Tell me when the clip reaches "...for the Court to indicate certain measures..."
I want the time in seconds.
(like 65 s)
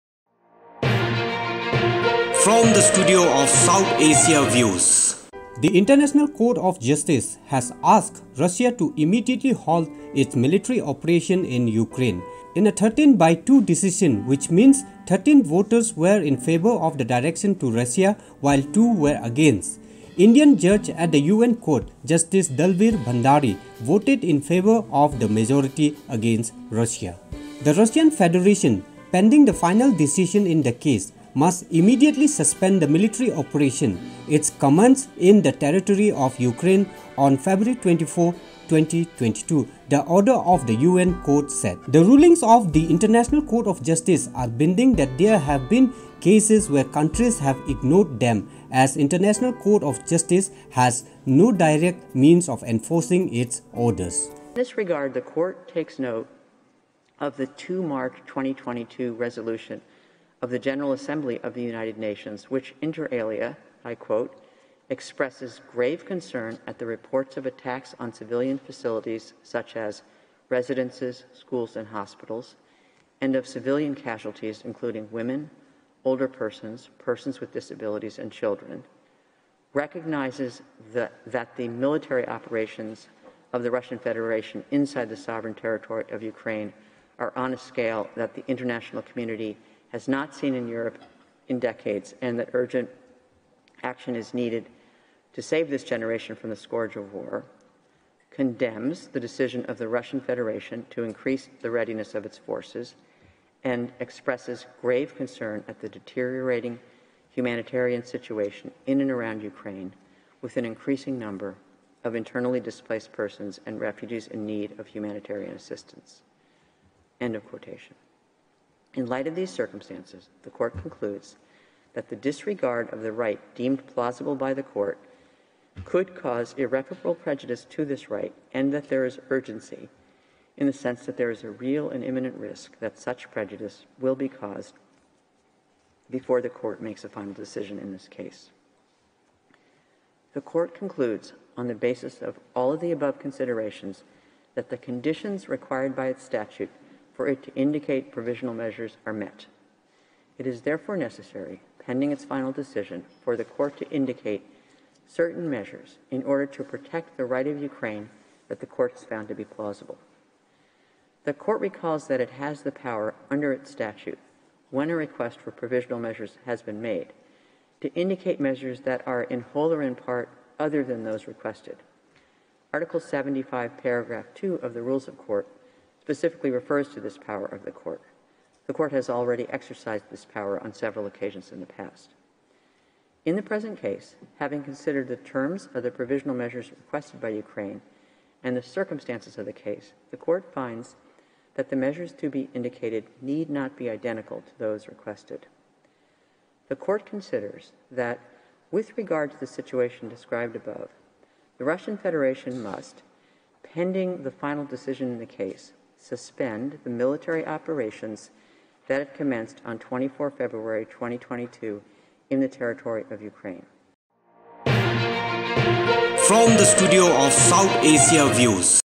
153 s.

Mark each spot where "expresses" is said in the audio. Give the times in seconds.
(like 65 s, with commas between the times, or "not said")
64 s, 103 s.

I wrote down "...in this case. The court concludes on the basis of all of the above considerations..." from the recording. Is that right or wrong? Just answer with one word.
right.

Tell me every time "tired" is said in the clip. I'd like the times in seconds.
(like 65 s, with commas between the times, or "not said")
not said.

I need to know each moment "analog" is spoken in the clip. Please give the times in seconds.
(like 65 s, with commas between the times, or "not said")
not said.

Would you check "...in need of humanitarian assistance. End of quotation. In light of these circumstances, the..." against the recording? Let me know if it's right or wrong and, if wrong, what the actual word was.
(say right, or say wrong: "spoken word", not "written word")
right.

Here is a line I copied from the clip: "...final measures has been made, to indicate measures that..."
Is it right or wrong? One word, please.
wrong.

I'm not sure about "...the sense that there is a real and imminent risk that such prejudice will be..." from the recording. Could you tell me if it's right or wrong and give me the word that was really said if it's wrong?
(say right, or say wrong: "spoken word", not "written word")
right.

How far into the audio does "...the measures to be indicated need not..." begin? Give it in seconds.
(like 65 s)
191 s.